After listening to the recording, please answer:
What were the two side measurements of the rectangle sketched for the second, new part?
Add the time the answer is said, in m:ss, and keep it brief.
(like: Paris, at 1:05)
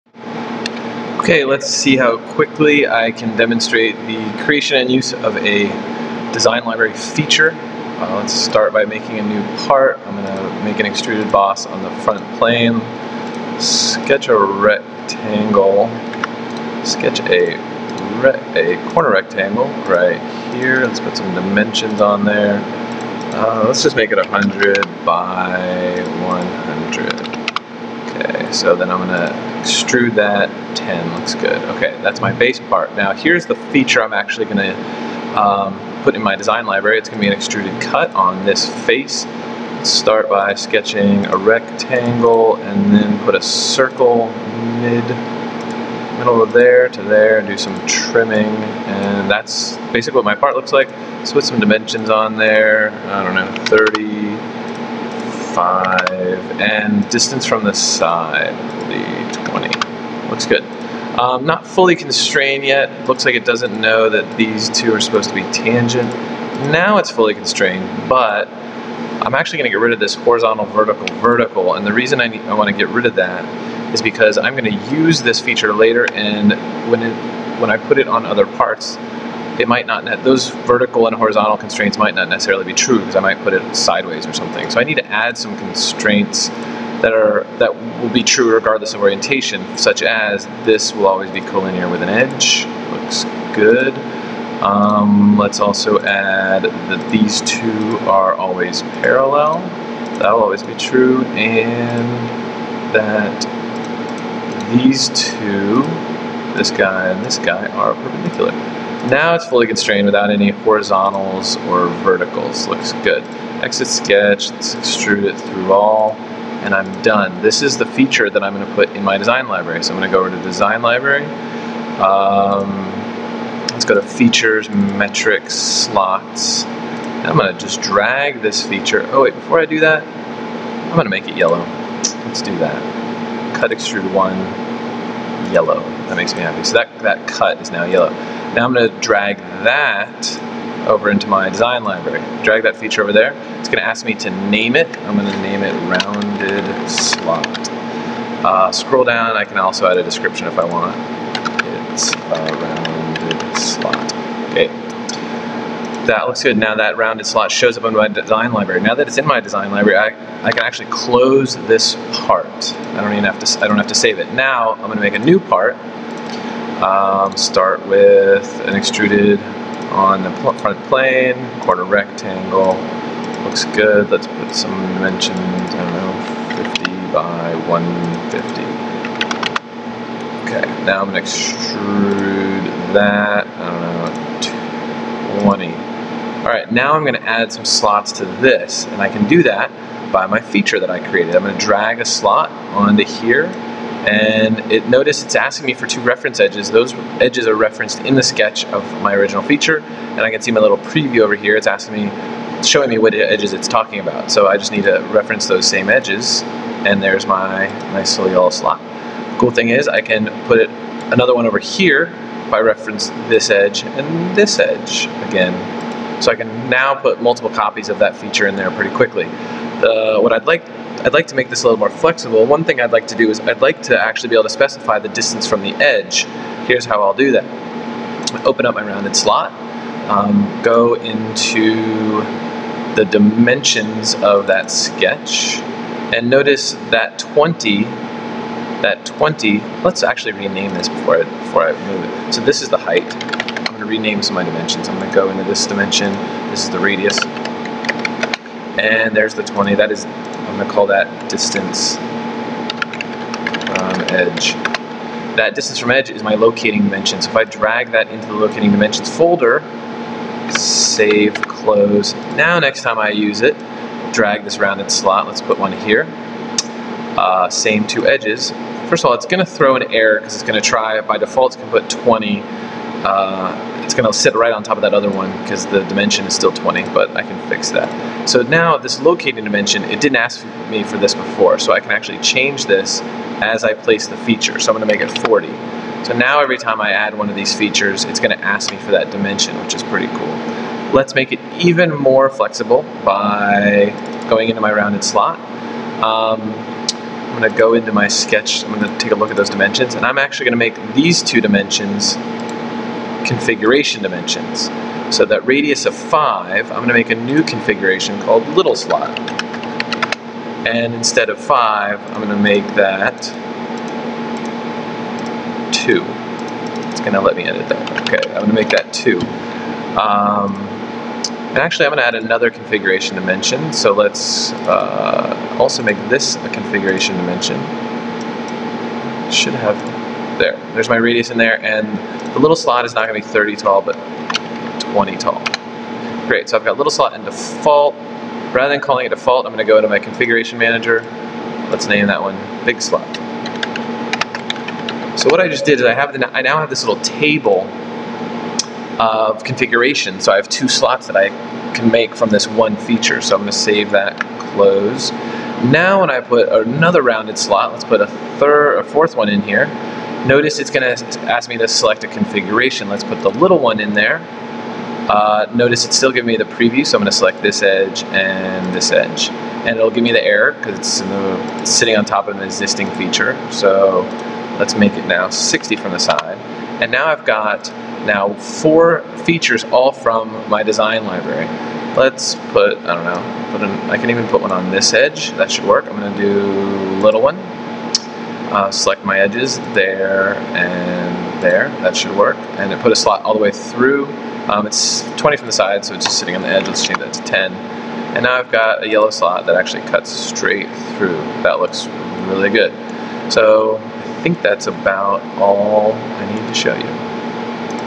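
50 by 150, at 2:56.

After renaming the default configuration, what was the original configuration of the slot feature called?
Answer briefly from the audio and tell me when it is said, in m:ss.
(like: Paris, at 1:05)
big slot, at 5:42.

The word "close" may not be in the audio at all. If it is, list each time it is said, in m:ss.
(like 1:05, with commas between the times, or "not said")
2:40, 4:21, 5:54.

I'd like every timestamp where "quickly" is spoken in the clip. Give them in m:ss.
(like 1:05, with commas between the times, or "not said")
0:02, 3:38.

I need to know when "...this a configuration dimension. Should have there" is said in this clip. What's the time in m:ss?
5:26.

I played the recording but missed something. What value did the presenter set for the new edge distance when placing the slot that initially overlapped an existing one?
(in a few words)
40.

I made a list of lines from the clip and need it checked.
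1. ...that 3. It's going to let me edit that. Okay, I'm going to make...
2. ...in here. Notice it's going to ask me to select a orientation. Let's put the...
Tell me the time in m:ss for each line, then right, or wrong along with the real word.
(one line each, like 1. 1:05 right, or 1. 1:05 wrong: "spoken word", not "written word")
1. 5:12 wrong: "2", not "3"
2. 5:59 wrong: "configuration", not "orientation".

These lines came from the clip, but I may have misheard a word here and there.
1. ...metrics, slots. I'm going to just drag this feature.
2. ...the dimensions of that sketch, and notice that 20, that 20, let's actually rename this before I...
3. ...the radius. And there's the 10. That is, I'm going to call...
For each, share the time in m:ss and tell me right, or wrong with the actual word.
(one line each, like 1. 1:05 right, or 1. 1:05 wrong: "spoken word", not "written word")
1. 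2:04 right
2. 3:52 right
3. 4:06 wrong: "20", not "10".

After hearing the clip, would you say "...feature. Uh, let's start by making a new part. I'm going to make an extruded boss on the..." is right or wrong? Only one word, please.
right.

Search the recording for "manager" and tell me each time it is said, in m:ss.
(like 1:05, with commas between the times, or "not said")
5:40.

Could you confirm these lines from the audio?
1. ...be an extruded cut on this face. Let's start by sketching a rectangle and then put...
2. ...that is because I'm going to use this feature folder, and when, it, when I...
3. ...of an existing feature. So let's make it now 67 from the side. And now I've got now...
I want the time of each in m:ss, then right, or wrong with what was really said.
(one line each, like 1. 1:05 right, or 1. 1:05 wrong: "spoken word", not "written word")
1. 0:37 right
2. 1:13 wrong: "later", not "folder"
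3. 6:12 wrong: "60", not "67".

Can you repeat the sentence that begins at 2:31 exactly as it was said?
It's a uh, round that looks good.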